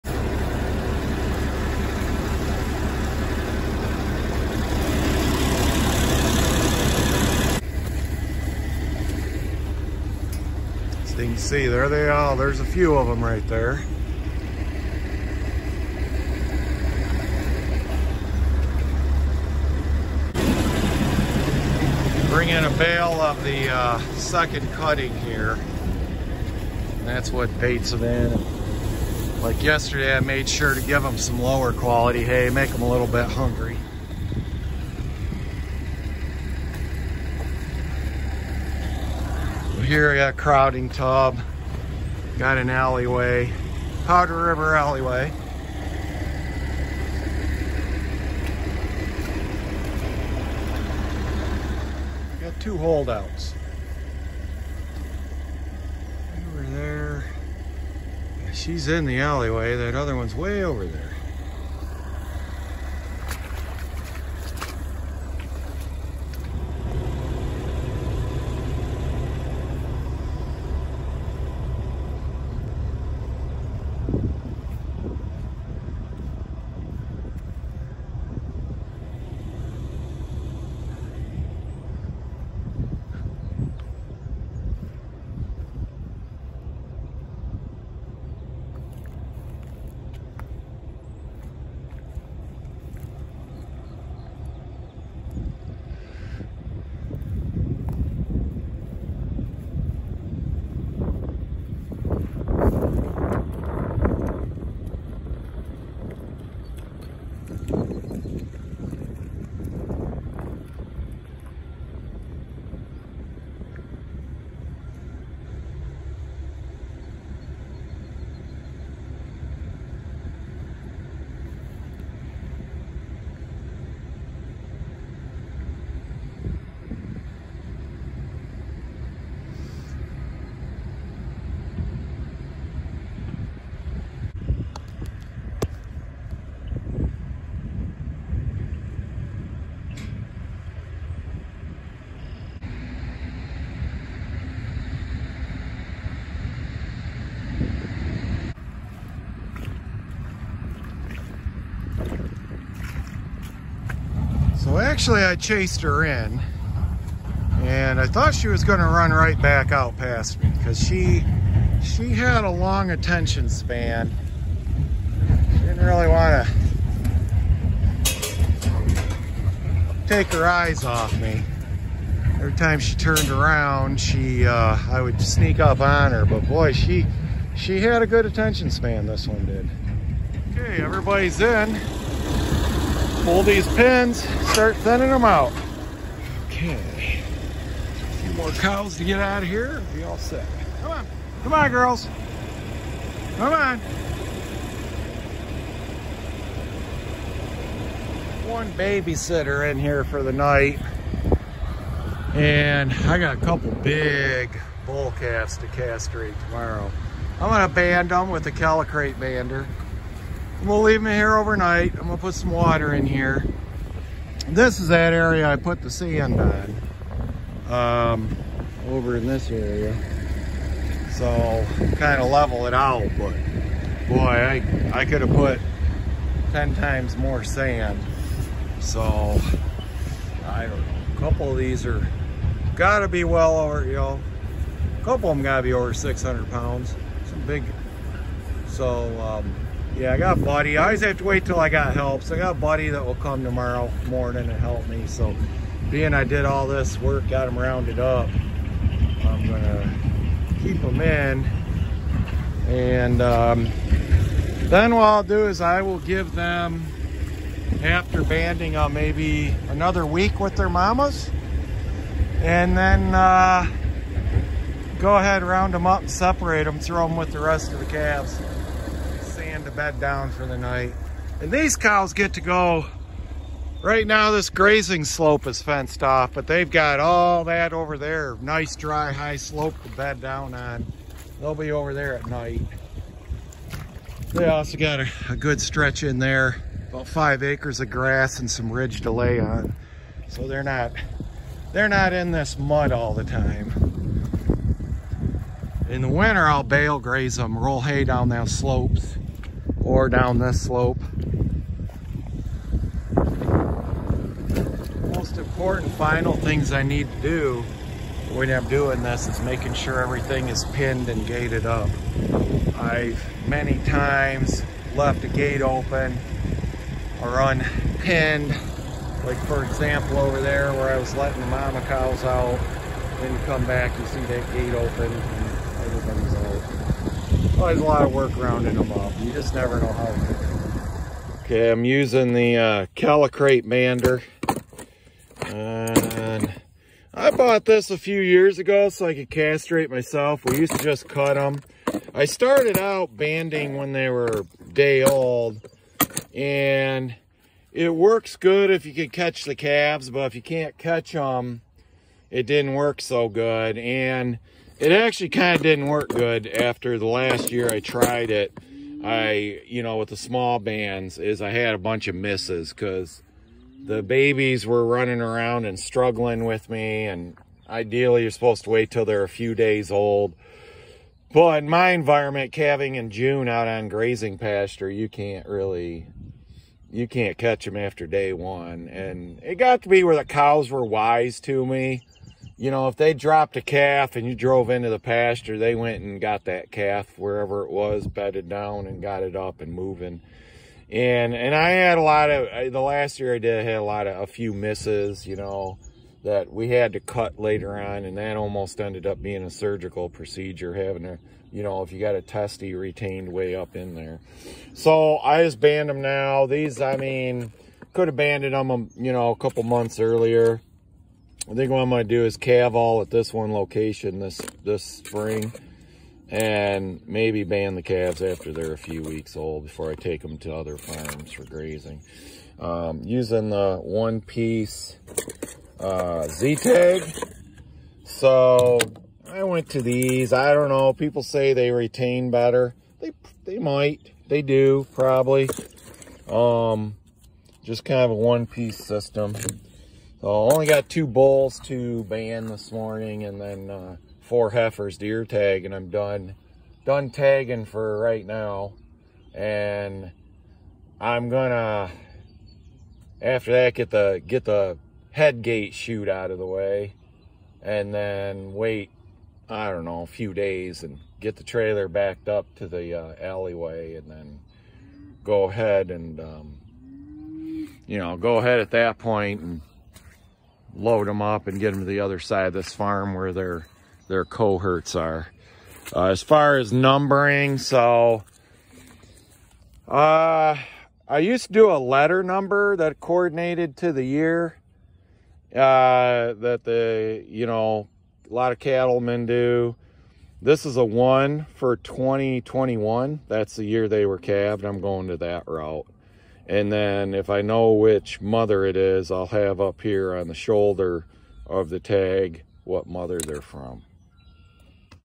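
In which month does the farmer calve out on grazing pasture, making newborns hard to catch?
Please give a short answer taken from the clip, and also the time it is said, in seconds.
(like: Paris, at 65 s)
June, at 373 s.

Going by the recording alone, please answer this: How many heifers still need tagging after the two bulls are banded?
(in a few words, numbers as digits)
4.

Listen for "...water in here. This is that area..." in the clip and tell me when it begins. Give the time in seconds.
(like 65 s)
212 s.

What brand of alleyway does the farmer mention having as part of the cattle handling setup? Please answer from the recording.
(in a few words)
Powder River.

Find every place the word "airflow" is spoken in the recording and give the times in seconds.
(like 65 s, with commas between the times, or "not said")
not said.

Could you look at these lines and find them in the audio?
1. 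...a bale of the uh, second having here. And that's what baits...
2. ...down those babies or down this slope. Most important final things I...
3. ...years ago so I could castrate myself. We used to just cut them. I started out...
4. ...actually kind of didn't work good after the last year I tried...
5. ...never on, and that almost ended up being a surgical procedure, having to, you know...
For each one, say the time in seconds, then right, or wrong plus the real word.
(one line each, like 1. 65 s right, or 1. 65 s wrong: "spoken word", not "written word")
1. 22 s wrong: "cutting", not "having"
2. 298 s wrong: "slopes", not "babies"
3. 338 s right
4. 354 s right
5. 397 s wrong: "later", not "never".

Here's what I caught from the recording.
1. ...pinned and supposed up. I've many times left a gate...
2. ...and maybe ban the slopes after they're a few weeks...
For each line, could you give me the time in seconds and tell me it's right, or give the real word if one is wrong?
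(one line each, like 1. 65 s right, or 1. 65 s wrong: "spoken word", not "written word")
1. 310 s wrong: "gated", not "supposed"
2. 416 s wrong: "calves", not "slopes".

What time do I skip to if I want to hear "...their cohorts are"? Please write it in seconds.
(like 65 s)
474 s.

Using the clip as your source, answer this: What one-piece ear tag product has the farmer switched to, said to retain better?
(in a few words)
Z-Tag.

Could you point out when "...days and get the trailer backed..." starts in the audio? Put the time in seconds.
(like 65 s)
460 s.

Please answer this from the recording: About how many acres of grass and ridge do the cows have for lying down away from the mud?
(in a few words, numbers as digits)
5 acres.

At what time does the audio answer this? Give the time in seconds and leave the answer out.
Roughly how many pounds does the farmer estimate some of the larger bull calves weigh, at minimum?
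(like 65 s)
235 s.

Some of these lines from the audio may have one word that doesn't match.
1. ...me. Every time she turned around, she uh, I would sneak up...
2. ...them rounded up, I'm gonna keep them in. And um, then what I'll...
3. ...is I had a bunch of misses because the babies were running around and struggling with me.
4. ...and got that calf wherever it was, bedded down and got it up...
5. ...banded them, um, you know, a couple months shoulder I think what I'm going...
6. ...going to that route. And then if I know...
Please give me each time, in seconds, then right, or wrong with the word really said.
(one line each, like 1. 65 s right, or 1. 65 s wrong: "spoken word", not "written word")
1. 171 s right
2. 247 s right
3. 361 s right
4. 386 s right
5. 408 s wrong: "earlier", not "shoulder"
6. 494 s right.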